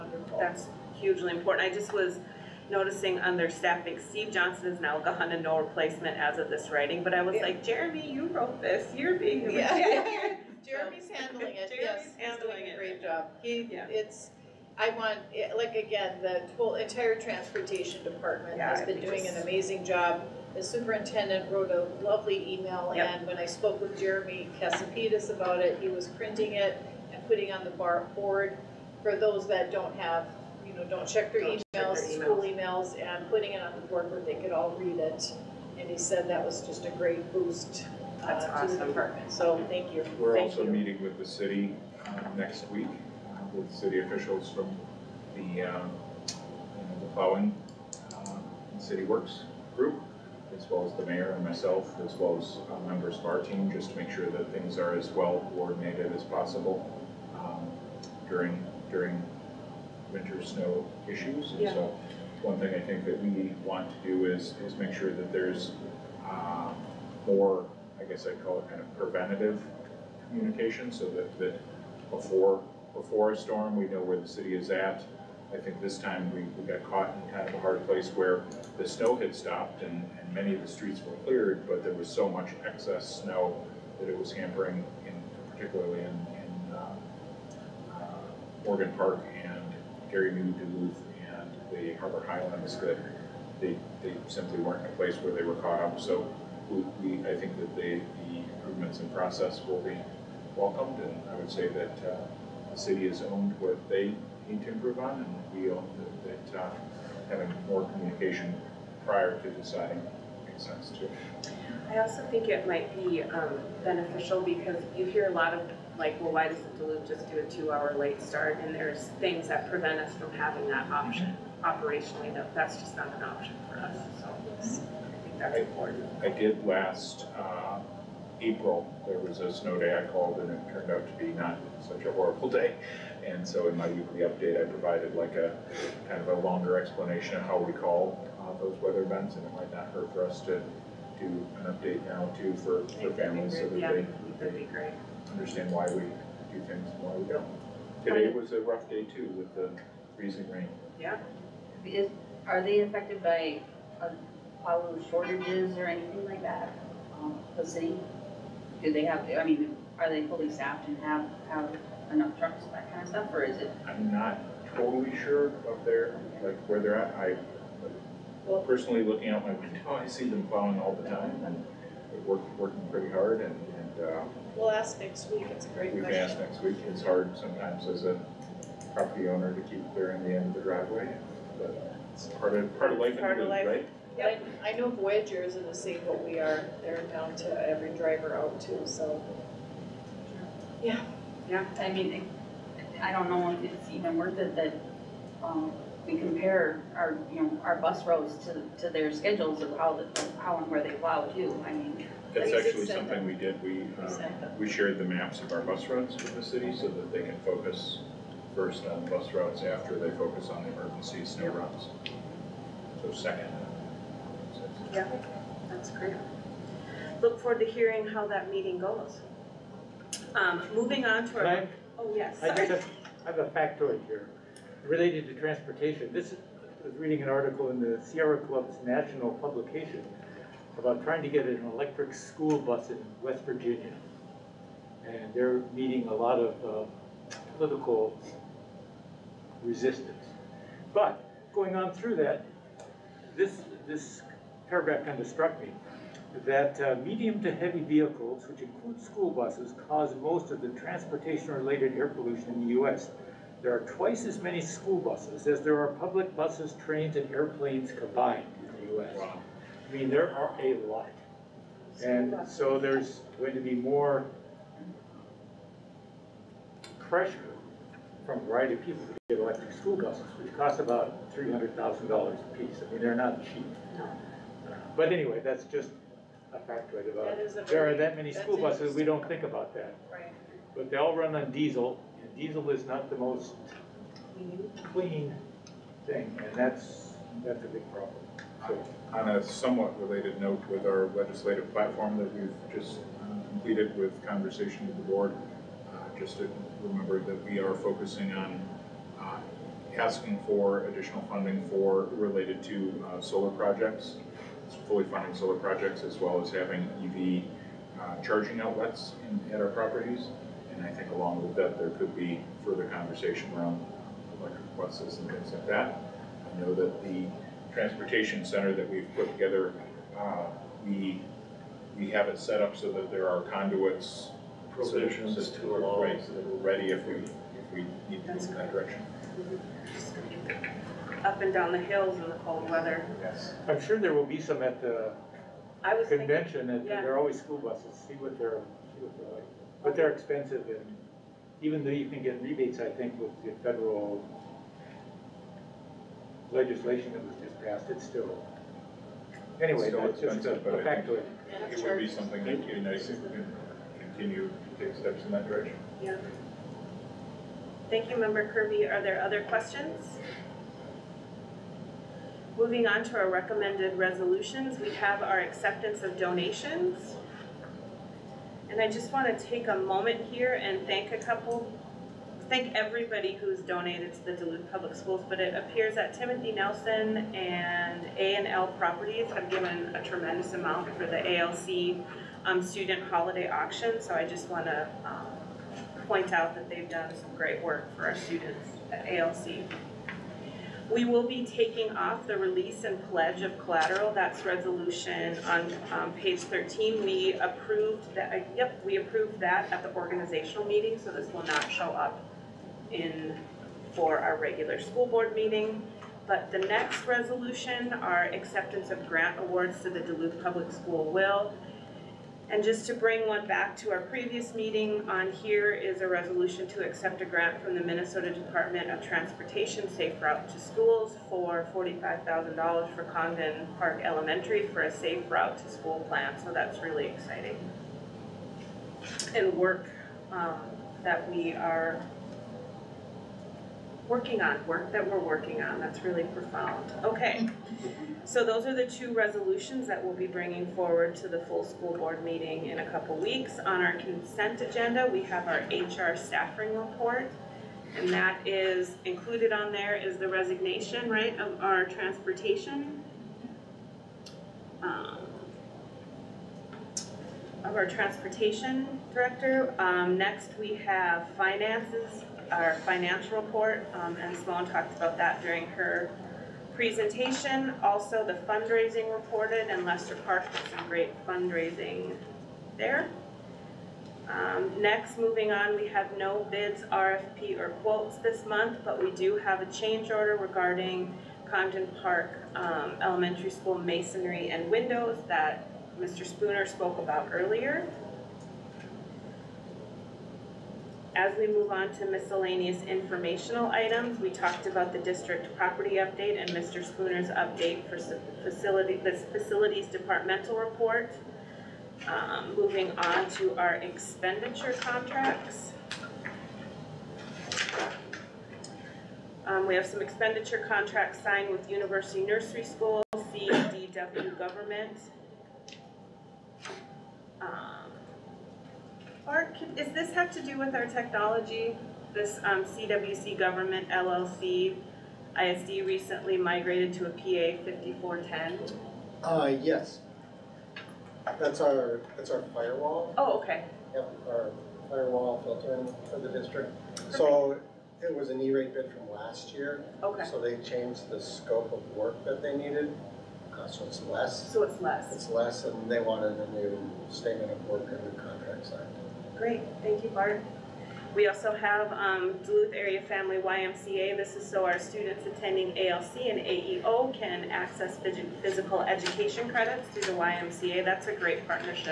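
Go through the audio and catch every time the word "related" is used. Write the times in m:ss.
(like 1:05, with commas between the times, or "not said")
3:44, 4:10, 4:49, 5:02.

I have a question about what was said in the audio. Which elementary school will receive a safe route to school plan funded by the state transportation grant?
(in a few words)
Congdon Park Elementary.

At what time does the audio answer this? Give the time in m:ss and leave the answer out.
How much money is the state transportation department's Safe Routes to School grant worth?
7:01.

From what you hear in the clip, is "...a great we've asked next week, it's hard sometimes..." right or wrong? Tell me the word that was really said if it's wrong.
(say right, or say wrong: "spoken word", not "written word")
right.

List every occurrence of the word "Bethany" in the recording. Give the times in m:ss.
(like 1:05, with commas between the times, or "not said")
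not said.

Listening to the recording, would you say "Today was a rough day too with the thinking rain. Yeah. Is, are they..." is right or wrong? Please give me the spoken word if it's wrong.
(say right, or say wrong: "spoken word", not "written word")
wrong: "freezing", not "thinking".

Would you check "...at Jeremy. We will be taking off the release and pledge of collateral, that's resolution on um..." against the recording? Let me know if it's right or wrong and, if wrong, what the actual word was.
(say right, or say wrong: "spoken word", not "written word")
wrong: "ALC", not "Jeremy".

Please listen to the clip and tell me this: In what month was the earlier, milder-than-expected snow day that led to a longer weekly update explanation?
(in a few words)
April.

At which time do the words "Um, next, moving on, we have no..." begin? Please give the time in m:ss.
7:54.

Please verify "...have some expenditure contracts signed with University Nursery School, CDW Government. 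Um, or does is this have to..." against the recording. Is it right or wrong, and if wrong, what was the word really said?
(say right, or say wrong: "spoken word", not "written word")
right.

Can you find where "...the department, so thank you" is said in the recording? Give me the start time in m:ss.
0:38.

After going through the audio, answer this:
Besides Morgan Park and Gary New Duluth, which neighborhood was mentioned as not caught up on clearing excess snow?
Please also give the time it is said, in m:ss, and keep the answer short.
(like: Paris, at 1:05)
Harbor Highlands, at 1:31.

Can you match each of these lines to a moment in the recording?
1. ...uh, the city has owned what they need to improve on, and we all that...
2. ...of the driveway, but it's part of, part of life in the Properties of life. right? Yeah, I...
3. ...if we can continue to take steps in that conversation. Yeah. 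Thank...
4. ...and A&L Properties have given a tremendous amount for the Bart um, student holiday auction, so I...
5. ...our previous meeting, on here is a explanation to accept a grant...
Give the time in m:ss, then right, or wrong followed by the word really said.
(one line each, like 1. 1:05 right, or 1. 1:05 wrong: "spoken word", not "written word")
1. 1:42 right
2. 3:00 wrong: "Part", not "Properties"
3. 5:53 wrong: "direction", not "conversation"
4. 6:17 wrong: "ALC", not "Bart"
5. 6:53 wrong: "resolution", not "explanation".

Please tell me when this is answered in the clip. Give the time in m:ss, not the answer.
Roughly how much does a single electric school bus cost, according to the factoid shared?
4:31.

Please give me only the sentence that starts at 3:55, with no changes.
And they're meeting a lot of, uh, political resistance.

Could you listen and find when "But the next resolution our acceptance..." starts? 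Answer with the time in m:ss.
6:46.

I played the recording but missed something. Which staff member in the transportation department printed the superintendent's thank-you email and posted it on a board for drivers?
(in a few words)
Jeremy Cassapetis.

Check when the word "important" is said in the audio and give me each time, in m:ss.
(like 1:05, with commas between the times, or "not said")
0:01, 2:05.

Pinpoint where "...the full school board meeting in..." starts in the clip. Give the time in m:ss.
7:21.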